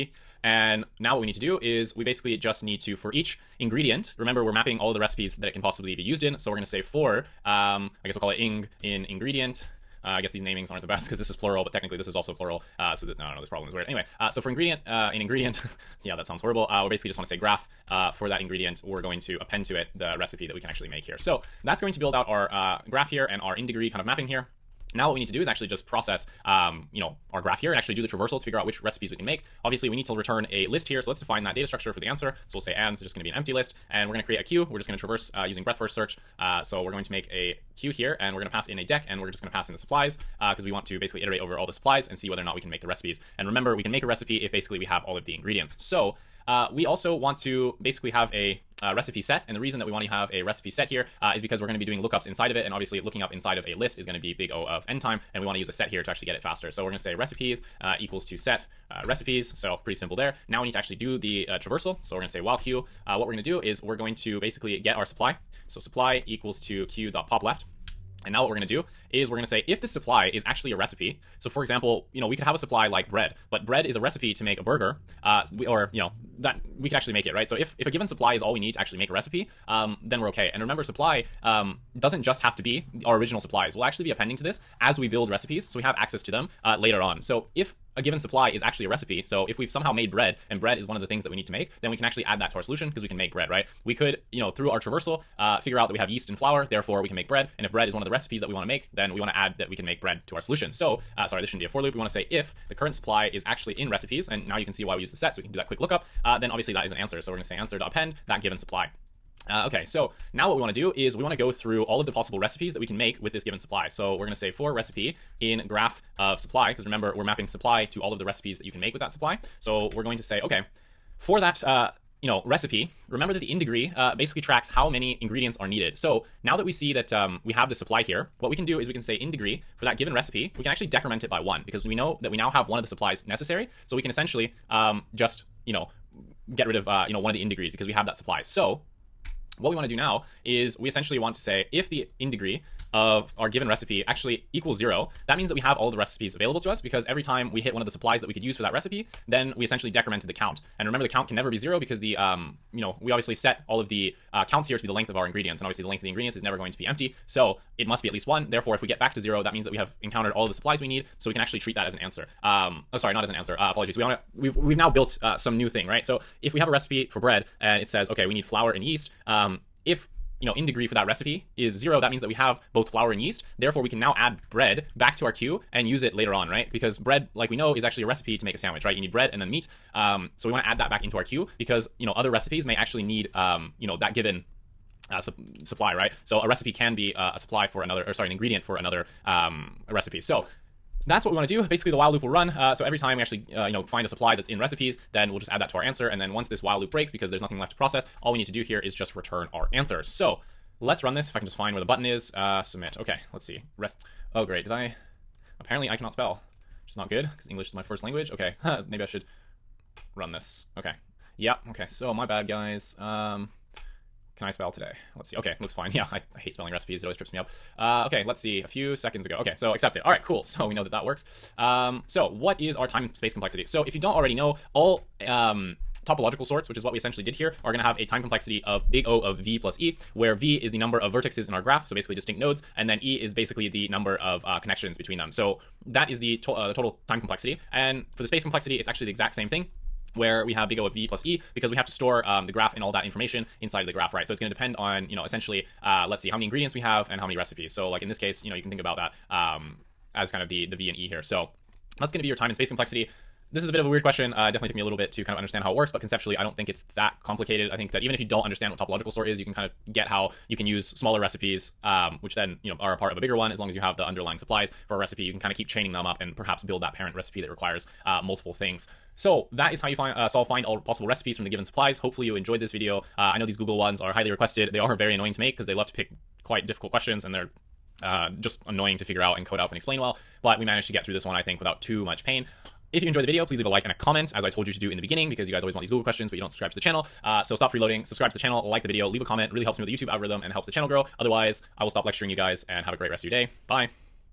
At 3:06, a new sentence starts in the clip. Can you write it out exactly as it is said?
So a recipe can be uh, a supply for another, or sorry, an ingredient for another um, recipe.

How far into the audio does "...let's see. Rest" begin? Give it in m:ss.
3:23.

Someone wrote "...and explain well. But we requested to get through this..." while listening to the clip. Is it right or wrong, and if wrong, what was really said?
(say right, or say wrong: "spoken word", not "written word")
wrong: "managed", not "requested".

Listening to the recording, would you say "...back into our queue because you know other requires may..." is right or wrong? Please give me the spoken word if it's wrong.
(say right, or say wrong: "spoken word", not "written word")
wrong: "recipes", not "requires".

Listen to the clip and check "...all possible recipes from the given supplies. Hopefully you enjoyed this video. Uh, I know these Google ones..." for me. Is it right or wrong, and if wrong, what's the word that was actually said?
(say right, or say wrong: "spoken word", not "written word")
right.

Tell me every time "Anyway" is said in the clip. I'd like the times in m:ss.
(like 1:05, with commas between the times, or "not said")
0:13.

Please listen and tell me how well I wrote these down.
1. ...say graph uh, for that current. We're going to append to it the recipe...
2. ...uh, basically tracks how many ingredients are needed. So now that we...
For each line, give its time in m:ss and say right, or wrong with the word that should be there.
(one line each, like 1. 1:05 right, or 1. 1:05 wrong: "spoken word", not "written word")
1. 0:17 wrong: "ingredient", not "current"
2. 2:03 right.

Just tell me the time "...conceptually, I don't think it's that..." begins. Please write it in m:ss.
4:16.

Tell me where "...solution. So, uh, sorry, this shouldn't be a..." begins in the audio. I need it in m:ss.
1:40.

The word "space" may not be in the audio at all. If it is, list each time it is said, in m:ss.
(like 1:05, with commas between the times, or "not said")
3:43, 3:58, 4:12.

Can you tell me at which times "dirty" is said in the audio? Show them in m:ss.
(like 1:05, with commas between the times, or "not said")
not said.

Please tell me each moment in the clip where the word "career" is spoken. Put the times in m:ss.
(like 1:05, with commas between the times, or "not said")
not said.